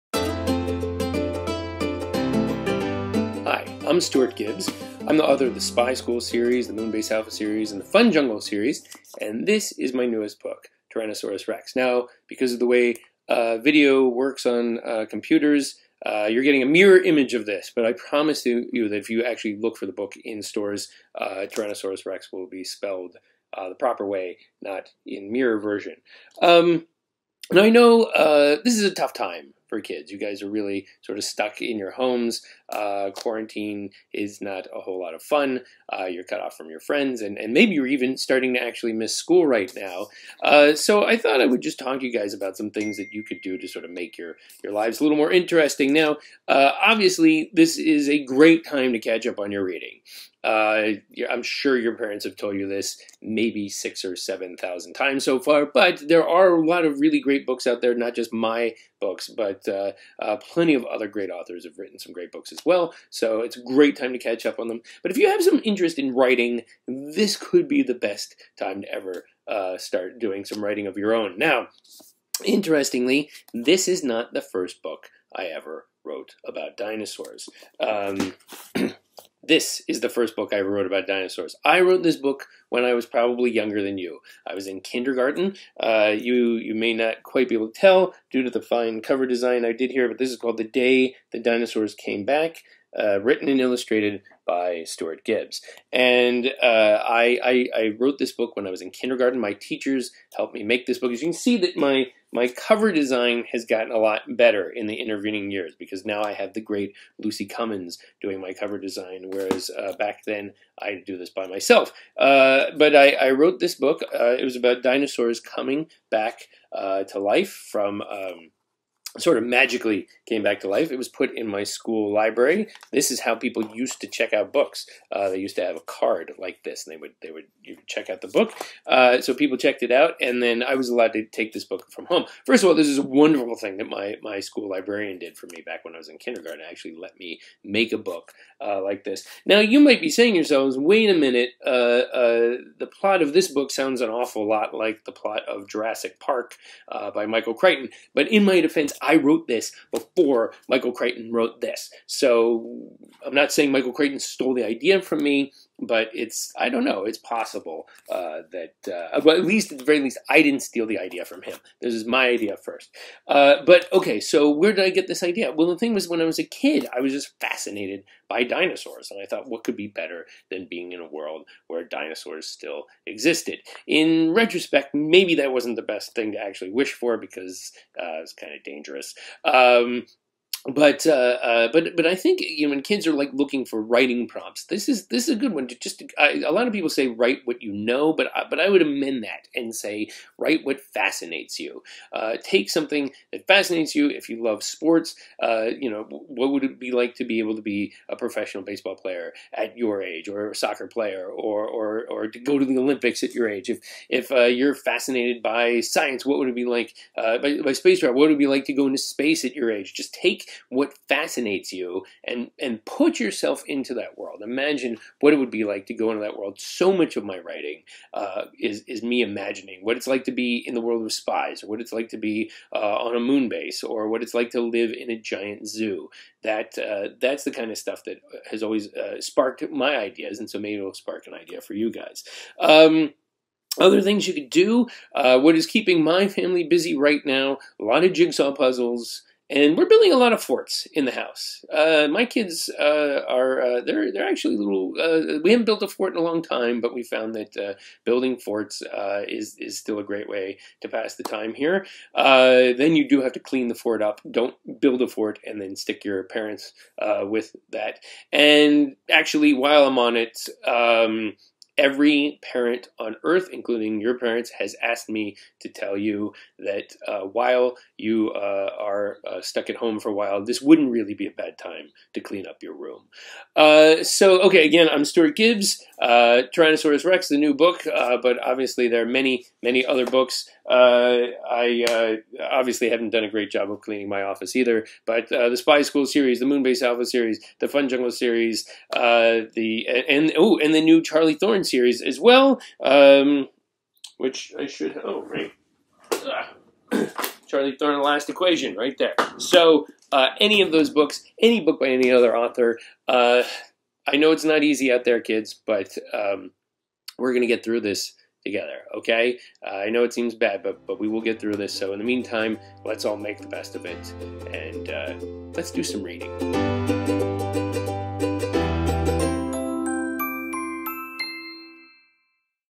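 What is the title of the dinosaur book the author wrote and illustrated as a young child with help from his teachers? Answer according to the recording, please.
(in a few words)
The Day the Dinosaurs Came Back.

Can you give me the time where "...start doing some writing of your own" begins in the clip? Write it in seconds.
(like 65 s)
69 s.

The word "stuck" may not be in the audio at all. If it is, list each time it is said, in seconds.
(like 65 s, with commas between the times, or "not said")
31 s, 269 s.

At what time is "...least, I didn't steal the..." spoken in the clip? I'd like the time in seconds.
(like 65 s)
159 s.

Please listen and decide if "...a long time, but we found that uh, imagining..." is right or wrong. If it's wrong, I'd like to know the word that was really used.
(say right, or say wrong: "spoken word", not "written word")
wrong: "building", not "imagining".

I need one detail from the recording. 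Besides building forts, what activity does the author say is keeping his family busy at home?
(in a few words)
jigsaw puzzles.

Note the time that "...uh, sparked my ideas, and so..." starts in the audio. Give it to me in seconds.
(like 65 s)
228 s.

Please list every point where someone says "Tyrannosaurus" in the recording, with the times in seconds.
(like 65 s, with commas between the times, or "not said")
10 s, 21 s, 276 s.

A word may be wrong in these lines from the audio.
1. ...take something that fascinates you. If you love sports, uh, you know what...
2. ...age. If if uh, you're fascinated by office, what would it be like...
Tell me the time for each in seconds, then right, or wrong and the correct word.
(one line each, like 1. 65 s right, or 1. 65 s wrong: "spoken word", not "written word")
1. 192 s right
2. 203 s wrong: "science", not "office".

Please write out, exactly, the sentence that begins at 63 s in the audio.
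So it's a great time to catch up on them.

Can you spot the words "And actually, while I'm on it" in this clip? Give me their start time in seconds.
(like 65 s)
258 s.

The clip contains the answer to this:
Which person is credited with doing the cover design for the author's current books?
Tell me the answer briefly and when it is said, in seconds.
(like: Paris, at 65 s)
Lucy Cummins, at 107 s.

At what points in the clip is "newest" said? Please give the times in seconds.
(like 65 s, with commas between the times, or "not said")
10 s.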